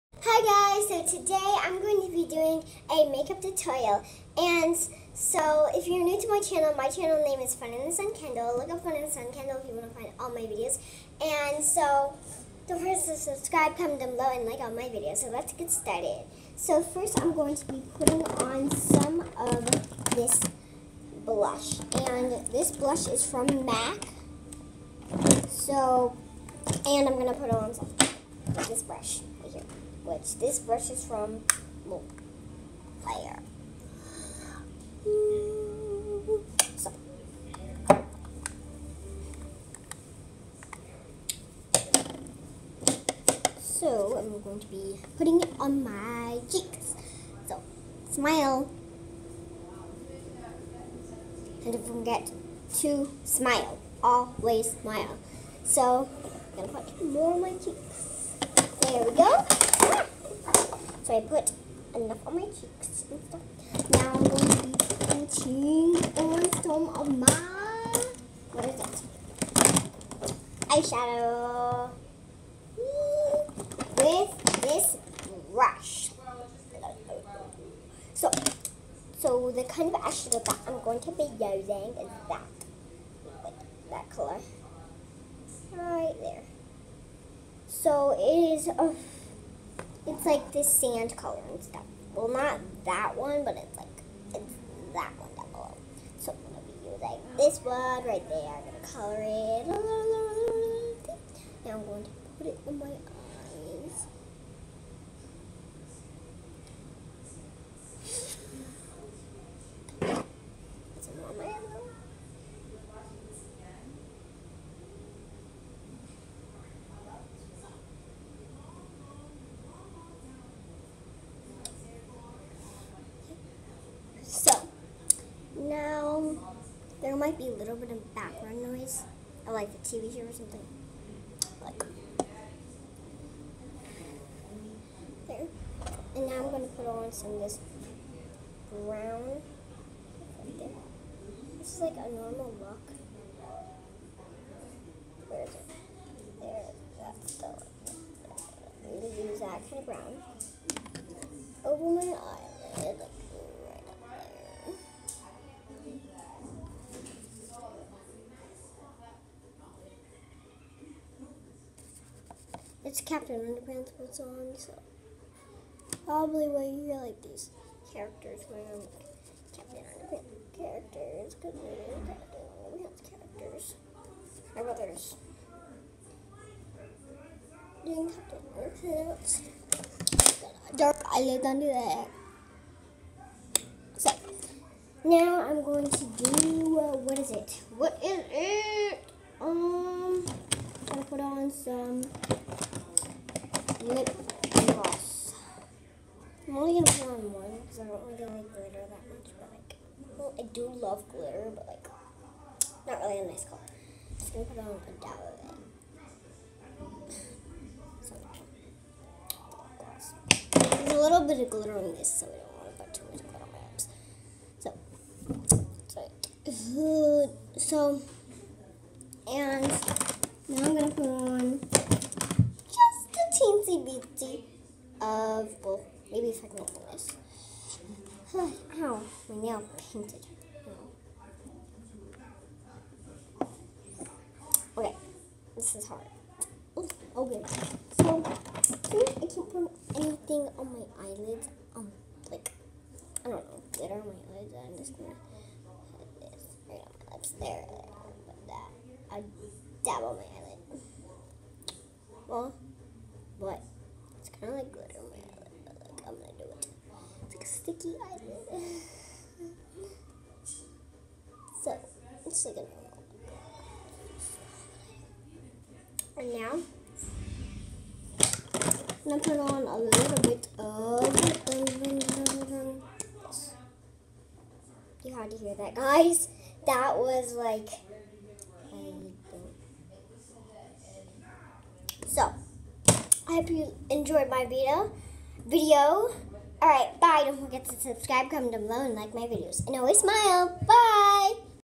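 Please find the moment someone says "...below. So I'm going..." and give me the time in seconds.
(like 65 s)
95 s.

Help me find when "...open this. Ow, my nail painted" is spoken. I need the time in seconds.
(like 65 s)
226 s.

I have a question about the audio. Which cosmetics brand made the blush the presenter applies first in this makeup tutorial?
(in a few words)
MAC.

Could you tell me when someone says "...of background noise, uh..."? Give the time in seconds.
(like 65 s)
127 s.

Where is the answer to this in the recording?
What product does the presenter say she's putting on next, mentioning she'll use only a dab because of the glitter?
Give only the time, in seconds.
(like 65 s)
193 s.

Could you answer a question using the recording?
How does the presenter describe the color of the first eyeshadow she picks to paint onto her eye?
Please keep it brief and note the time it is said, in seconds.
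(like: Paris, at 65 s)
sand, at 90 s.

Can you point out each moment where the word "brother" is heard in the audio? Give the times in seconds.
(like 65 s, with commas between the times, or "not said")
174 s.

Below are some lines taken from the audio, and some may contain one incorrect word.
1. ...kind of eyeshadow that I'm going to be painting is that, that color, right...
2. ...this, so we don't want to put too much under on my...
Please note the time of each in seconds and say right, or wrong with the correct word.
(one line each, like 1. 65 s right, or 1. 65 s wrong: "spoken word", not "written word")
1. 79 s wrong: "using", not "painting"
2. 211 s wrong: "glitter", not "under".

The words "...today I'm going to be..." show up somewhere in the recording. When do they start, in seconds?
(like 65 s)
1 s.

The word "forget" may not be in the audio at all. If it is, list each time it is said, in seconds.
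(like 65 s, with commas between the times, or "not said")
12 s, 51 s, 287 s.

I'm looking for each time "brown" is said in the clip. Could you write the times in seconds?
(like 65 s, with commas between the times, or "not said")
138 s, 149 s.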